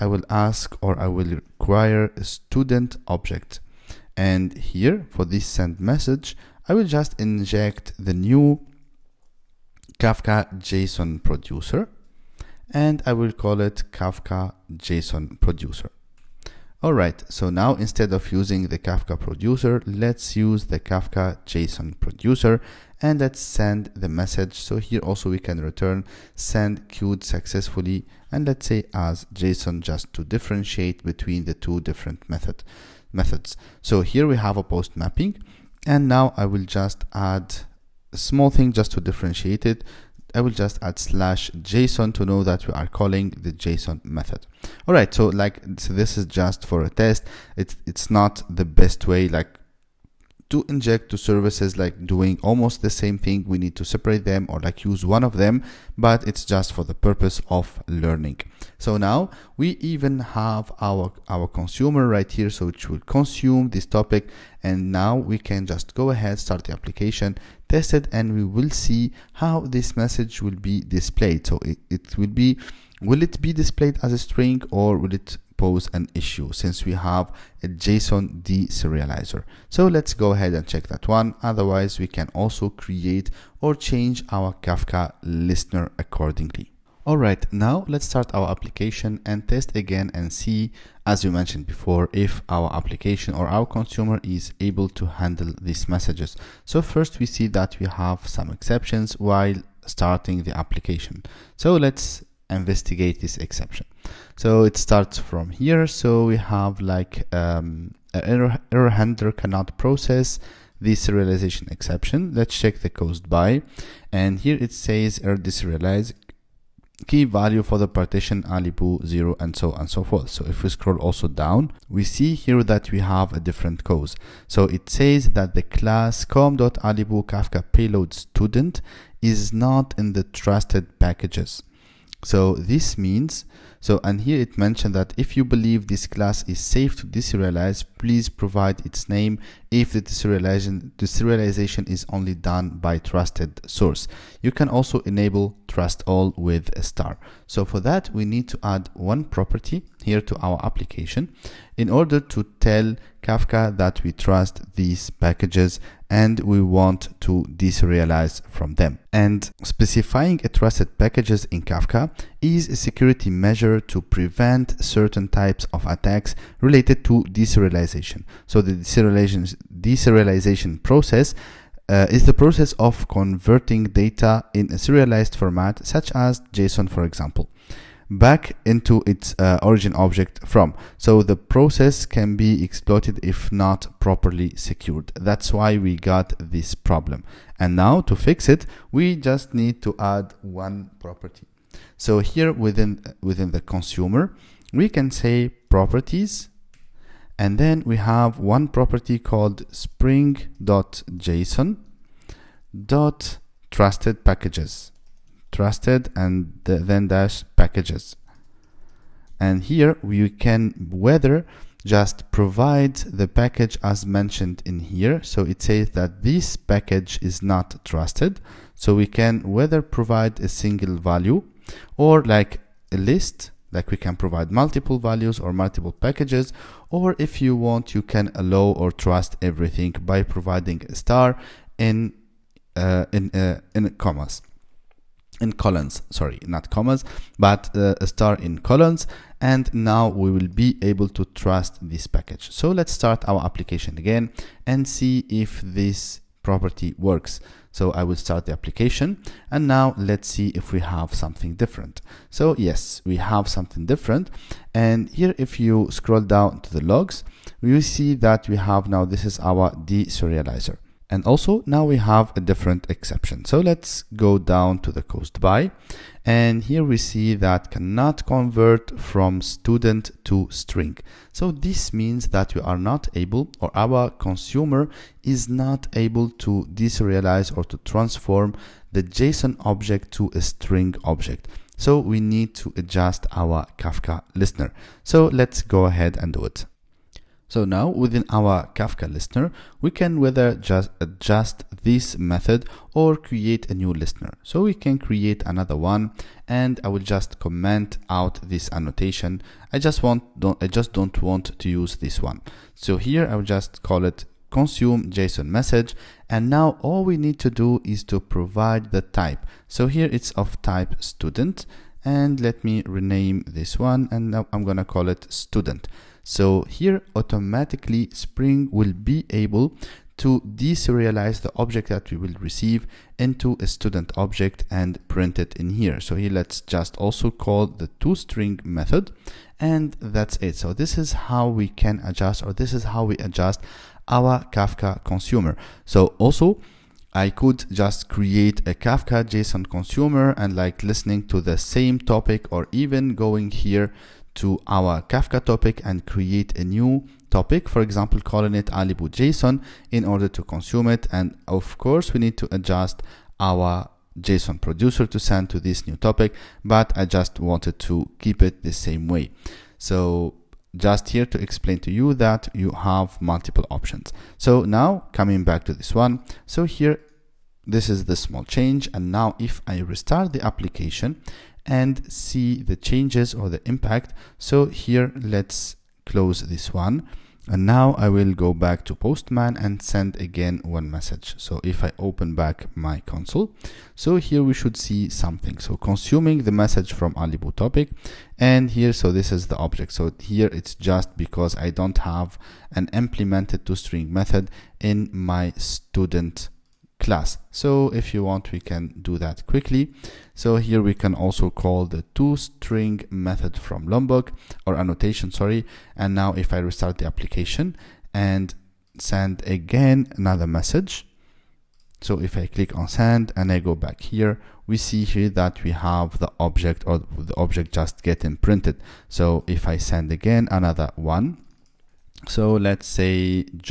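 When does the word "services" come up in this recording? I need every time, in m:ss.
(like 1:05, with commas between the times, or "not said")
0:51.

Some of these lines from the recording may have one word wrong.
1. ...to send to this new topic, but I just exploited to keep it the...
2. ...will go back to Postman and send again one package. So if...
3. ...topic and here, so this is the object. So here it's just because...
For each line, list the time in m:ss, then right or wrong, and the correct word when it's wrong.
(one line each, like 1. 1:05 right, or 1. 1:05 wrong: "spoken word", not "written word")
1. 5:55 wrong: "wanted", not "exploited"
2. 6:18 wrong: "message", not "package"
3. 6:27 right.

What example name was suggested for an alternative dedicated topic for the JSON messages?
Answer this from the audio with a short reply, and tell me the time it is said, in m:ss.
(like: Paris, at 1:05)
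alibou.json, at 5:48.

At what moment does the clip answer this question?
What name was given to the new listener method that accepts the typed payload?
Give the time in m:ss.
5:04.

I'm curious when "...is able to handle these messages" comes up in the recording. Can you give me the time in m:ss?
1:34.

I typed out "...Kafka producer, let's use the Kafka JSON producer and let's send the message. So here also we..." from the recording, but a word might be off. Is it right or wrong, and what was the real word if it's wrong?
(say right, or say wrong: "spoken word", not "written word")
right.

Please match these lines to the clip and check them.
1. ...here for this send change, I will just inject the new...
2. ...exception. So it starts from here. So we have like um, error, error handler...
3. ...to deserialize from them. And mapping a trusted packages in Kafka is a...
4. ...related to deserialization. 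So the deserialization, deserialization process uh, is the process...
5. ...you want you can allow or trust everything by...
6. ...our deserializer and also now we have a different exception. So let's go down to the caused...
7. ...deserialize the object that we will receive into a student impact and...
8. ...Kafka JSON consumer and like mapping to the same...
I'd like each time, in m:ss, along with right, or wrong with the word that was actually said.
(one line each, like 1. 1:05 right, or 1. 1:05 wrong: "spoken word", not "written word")
1. 0:04 wrong: "message", not "change"
2. 1:43 right
3. 2:37 wrong: "specifying", not "mapping"
4. 2:46 right
5. 3:47 right
6. 4:19 right
7. 5:20 wrong: "object", not "impact"
8. 5:38 wrong: "listening", not "mapping".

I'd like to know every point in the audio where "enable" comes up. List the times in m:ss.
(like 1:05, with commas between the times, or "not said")
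2:25.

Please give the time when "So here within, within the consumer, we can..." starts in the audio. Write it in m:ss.
3:11.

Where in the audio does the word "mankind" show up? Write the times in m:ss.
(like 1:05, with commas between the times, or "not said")
not said.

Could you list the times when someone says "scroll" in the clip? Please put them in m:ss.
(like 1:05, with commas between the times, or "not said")
2:00, 4:15.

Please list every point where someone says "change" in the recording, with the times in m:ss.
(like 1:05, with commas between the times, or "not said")
1:23, 6:08, 6:12.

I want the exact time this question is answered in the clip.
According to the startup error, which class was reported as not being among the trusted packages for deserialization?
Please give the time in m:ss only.
2:06.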